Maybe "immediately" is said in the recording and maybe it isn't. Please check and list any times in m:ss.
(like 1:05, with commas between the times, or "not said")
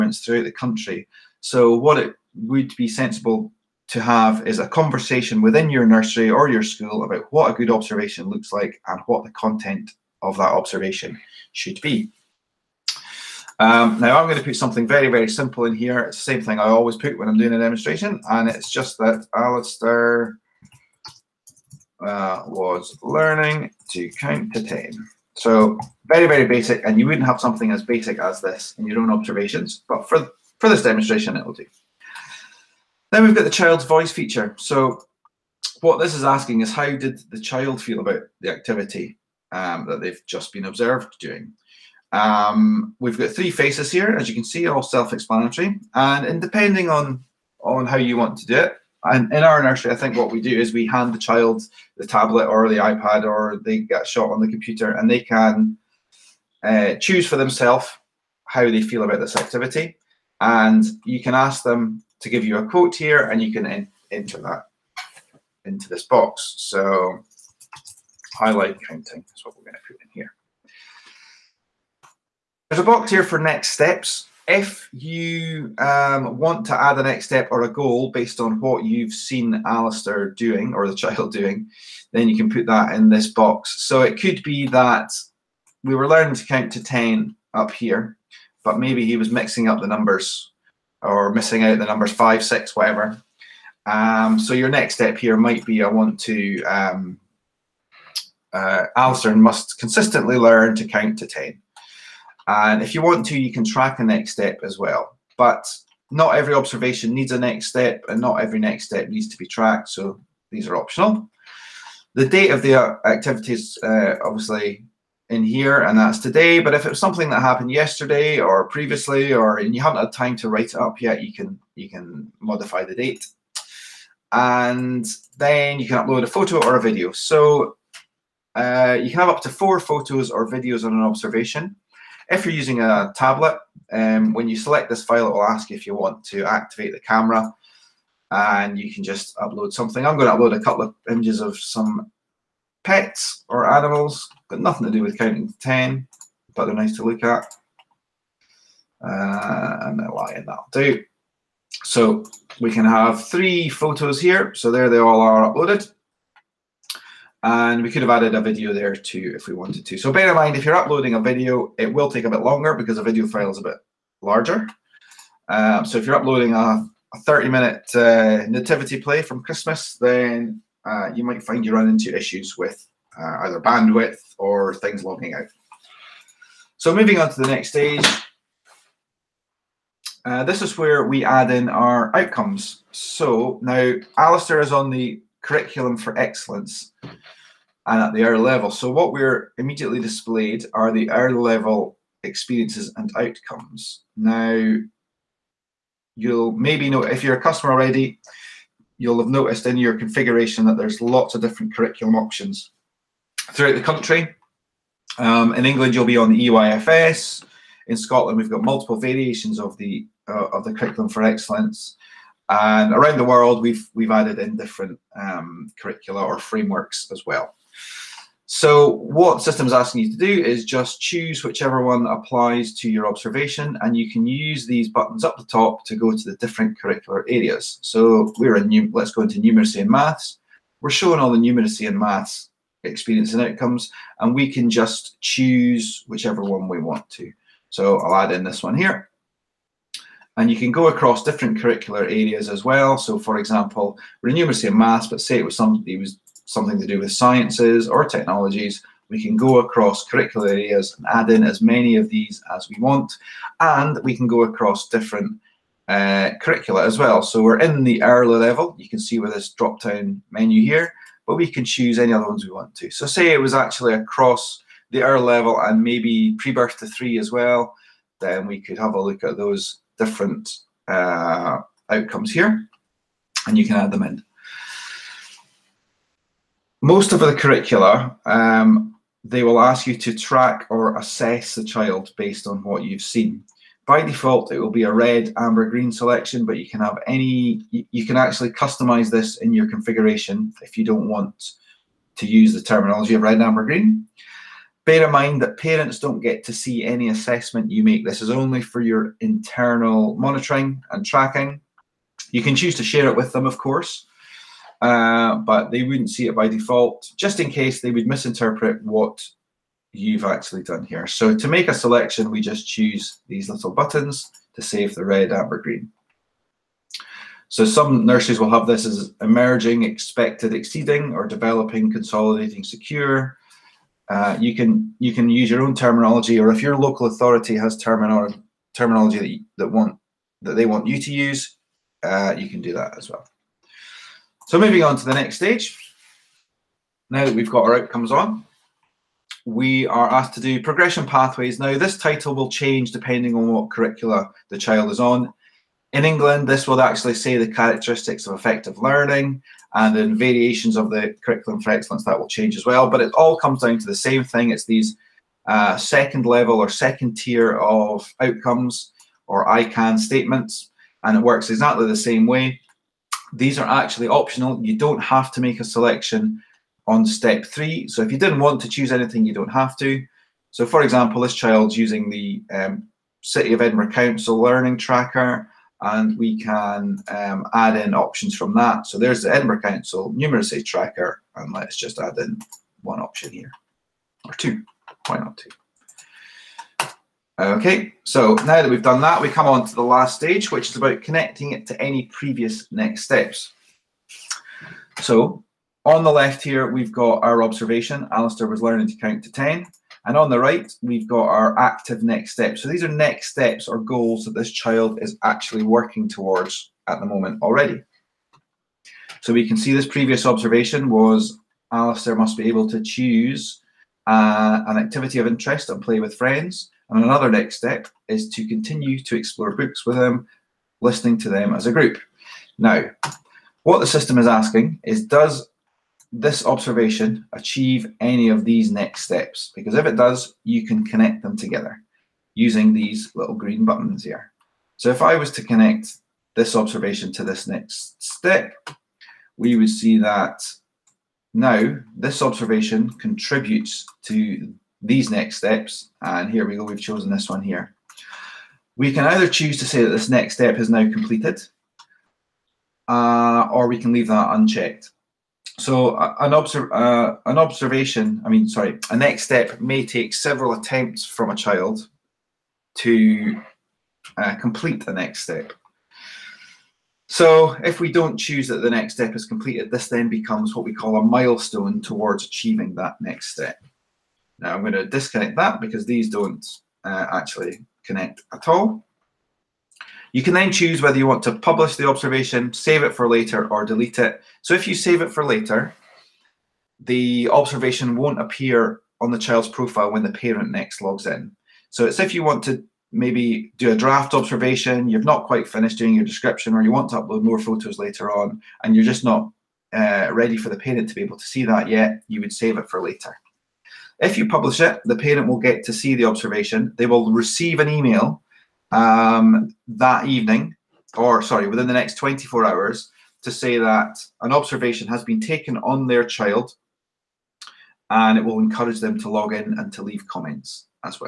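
3:09.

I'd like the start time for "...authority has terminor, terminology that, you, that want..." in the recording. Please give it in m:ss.
5:27.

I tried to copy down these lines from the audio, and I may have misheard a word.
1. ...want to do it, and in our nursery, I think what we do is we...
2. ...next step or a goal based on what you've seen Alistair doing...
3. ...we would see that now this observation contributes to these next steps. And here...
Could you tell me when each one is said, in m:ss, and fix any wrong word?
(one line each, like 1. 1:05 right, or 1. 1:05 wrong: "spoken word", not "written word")
1. 0:48 right
2. 1:17 right
3. 7:19 right.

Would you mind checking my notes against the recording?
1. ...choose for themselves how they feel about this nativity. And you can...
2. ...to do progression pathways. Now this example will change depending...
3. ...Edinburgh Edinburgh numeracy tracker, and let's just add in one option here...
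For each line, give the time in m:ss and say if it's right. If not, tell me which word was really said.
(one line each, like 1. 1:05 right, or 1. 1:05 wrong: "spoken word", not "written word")
1. 0:56 wrong: "activity", not "nativity"
2. 5:40 wrong: "title", not "example"
3. 6:19 wrong: "Council", not "Edinburgh".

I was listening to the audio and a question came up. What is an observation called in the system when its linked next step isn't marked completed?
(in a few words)
Milestone.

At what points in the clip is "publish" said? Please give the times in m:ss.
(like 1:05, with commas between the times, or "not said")
8:01, 8:24.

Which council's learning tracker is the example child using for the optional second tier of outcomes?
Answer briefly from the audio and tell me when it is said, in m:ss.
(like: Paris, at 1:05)
City of Edinburgh Council, at 6:13.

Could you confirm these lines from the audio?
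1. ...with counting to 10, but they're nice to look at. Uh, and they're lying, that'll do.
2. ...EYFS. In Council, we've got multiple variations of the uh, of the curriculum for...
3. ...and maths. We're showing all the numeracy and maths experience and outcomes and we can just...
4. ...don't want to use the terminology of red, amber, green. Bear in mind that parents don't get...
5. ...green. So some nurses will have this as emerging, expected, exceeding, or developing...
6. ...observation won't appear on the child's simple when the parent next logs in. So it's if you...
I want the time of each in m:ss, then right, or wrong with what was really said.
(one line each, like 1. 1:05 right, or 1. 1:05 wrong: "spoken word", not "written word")
1. 2:25 right
2. 3:26 wrong: "Scotland", not "Council"
3. 3:49 right
4. 4:50 right
5. 5:15 right
6. 8:07 wrong: "profile", not "simple".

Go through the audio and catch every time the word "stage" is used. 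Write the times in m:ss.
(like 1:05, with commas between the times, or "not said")
2:57, 5:35, 6:30.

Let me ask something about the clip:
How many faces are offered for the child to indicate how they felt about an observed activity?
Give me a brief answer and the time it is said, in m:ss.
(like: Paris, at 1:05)
3, at 0:43.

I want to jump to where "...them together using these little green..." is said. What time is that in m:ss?
7:11.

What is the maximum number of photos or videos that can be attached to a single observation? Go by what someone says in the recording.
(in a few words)
4.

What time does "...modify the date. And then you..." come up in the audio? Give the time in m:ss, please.
2:02.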